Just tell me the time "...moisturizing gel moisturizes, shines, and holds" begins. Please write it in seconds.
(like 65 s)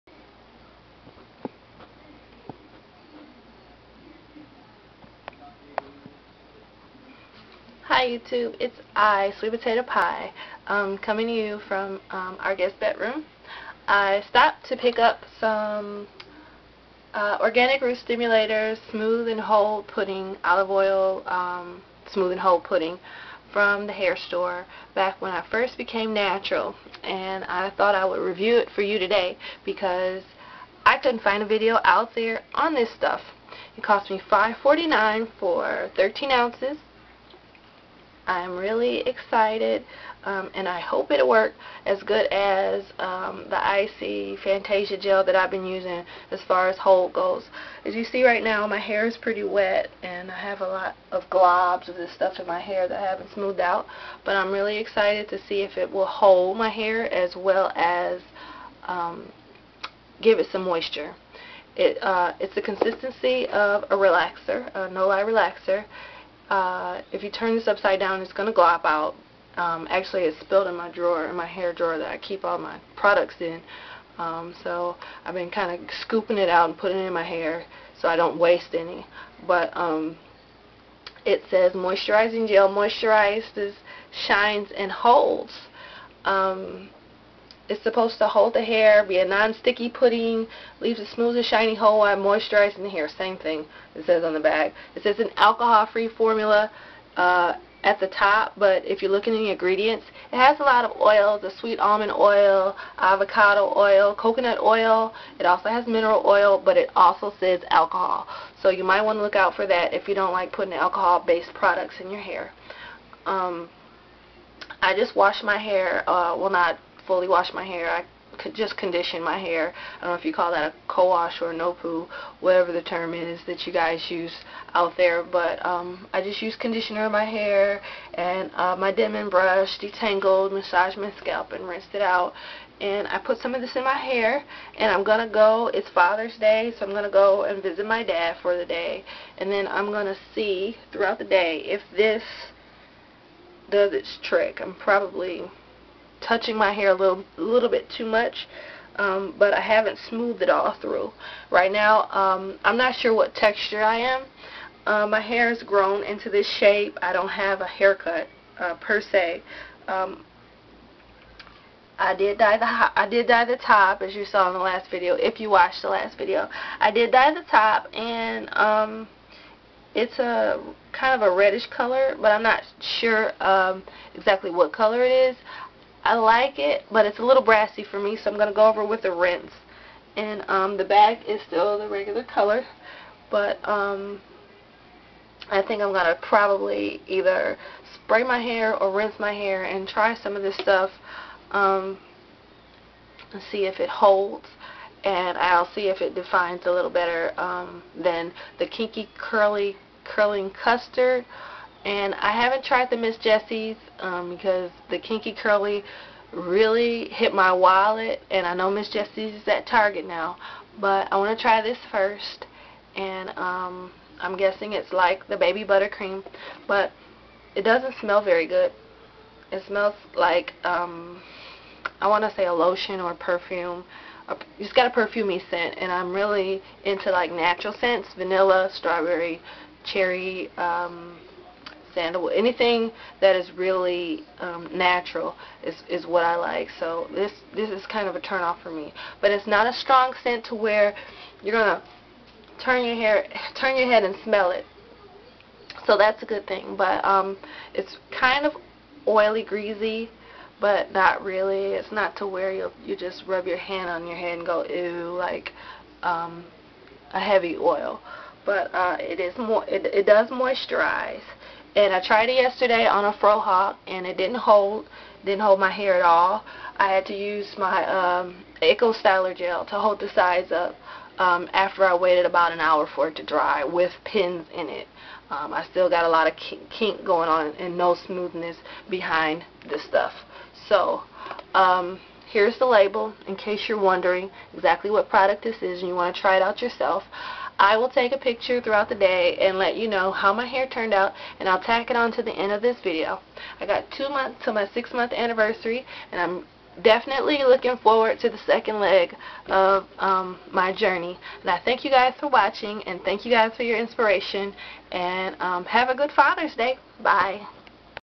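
81 s.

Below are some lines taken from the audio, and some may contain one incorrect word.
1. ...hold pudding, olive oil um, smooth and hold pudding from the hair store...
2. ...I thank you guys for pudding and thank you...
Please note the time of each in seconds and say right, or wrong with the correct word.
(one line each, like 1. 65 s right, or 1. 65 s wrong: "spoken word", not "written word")
1. 19 s right
2. 301 s wrong: "watching", not "pudding".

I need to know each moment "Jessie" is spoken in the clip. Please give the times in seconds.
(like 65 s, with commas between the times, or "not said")
203 s, 208 s.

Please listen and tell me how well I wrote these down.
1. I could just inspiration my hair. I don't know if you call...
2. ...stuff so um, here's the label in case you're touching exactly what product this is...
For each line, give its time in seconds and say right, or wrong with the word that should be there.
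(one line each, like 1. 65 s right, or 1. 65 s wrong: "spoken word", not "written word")
1. 117 s wrong: "condition", not "inspiration"
2. 279 s wrong: "wondering", not "touching".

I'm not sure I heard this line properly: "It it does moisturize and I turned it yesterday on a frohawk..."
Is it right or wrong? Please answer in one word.
wrong.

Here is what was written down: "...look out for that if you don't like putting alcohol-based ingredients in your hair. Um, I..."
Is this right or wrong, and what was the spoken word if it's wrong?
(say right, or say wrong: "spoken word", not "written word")
wrong: "products", not "ingredients".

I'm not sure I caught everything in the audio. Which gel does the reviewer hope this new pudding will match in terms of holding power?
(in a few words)
IC Fantasia gel.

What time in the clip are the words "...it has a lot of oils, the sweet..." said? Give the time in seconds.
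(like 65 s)
100 s.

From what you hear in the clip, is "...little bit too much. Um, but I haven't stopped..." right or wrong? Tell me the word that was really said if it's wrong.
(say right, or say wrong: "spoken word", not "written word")
wrong: "smoothed", not "stopped".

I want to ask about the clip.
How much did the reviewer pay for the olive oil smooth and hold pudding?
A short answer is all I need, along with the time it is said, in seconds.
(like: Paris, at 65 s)
$5.49, at 34 s.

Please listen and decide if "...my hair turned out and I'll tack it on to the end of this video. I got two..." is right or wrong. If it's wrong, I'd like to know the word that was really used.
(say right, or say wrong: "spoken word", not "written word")
right.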